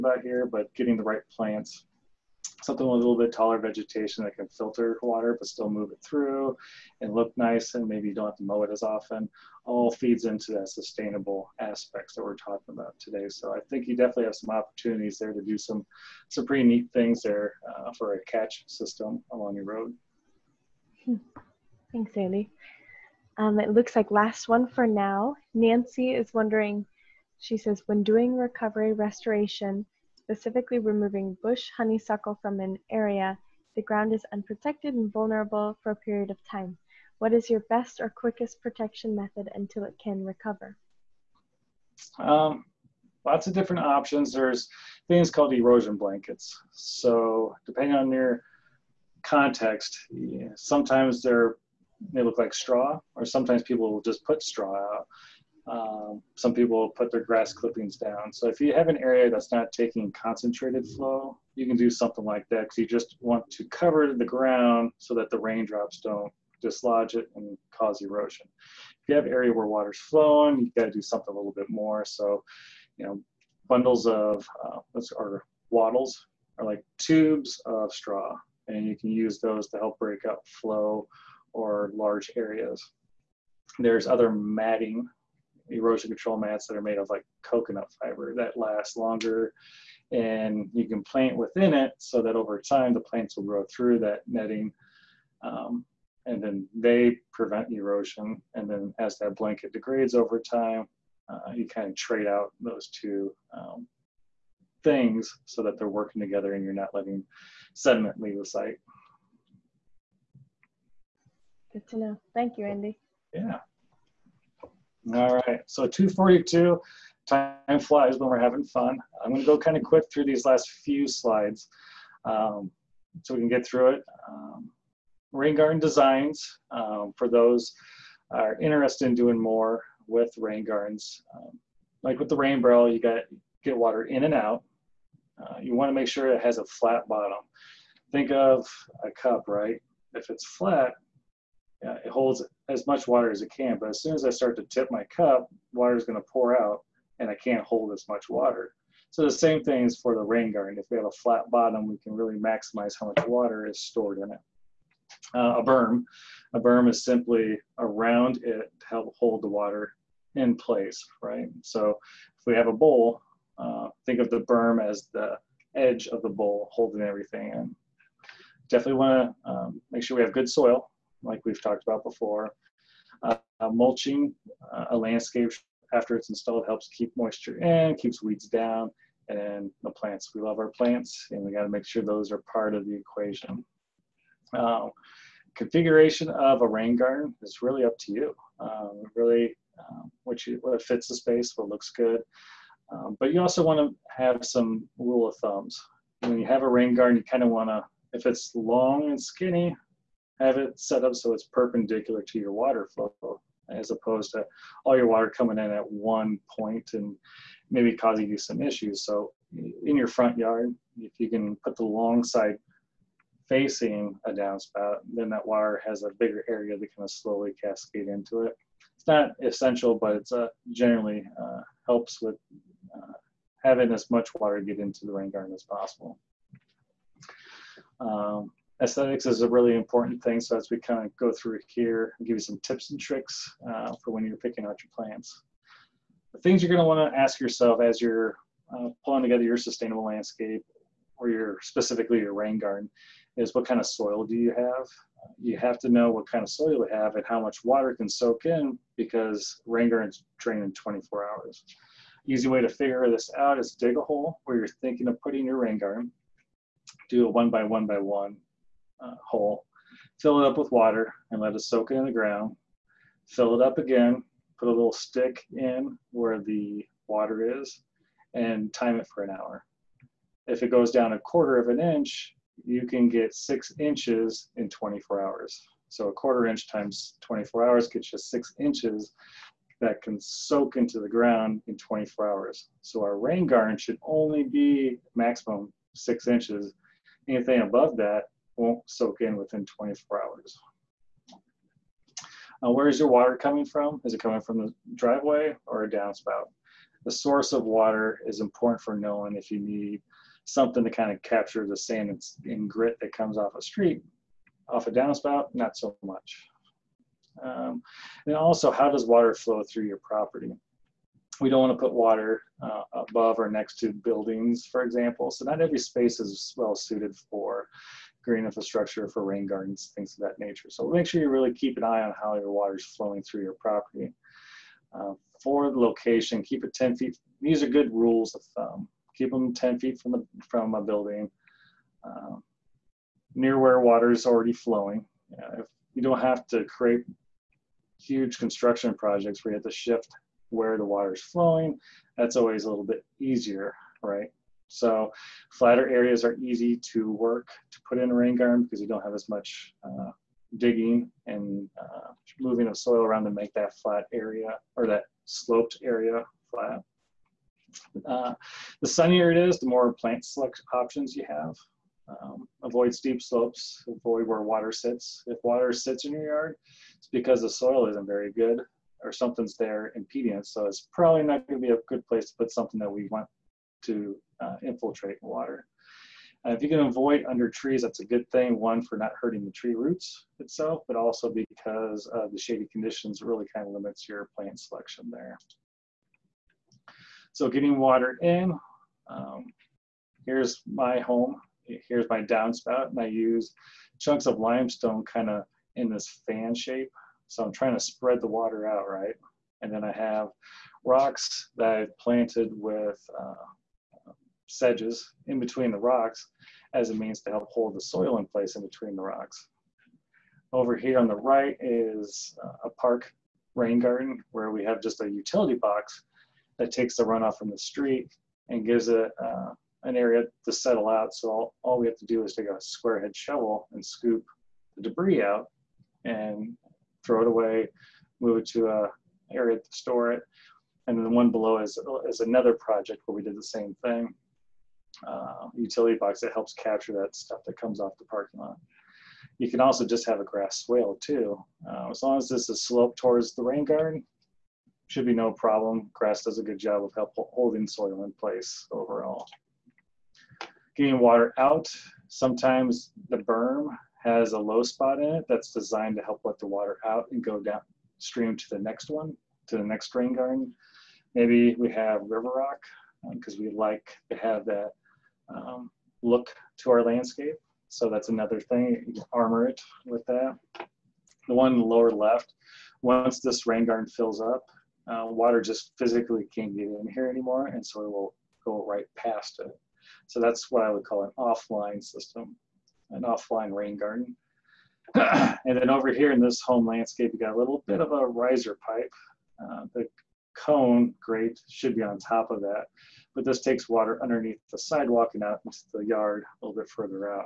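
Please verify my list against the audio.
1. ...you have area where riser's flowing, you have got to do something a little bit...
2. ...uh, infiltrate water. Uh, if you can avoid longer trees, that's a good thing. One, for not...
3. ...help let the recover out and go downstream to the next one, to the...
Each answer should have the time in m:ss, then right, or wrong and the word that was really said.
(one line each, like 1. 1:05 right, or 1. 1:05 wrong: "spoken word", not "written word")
1. 1:09 wrong: "water", not "riser"
2. 6:14 wrong: "under", not "longer"
3. 7:36 wrong: "water", not "recover".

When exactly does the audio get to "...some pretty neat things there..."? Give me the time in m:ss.
0:16.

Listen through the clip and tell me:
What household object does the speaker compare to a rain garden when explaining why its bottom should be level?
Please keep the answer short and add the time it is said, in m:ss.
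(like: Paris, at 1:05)
a cup, at 2:19.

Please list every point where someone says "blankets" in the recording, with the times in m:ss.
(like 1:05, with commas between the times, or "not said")
0:45, 1:39.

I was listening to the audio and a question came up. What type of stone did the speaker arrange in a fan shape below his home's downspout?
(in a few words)
limestone.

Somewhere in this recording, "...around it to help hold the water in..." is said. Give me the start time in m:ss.
2:37.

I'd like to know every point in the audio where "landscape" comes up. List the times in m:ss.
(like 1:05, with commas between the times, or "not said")
2:54, 4:00, 7:46, 8:06.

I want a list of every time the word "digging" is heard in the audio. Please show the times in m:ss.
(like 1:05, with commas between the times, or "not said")
5:50.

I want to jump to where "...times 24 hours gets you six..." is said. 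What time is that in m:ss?
4:36.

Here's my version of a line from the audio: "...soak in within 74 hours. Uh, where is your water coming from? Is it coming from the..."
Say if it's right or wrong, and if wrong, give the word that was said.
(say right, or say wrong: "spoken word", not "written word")
wrong: "24", not "74".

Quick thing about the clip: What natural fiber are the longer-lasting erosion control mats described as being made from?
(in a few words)
coconut fiber.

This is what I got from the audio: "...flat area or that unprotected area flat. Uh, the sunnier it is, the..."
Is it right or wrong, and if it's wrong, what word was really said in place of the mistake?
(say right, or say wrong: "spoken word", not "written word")
wrong: "sloped", not "unprotected".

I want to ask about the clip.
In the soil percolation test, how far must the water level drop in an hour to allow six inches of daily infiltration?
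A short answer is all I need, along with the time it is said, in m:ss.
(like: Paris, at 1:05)
a quarter of an inch, at 4:31.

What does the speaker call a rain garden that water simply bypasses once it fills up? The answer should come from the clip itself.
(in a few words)
offline rain garden.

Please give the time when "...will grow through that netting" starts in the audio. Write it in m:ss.
1:33.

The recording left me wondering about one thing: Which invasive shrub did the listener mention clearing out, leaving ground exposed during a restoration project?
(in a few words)
bush honeysuckle.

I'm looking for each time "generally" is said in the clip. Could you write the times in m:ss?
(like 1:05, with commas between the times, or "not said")
3:40.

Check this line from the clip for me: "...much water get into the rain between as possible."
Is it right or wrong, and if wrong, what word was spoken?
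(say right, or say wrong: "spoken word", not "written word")
wrong: "garden", not "between".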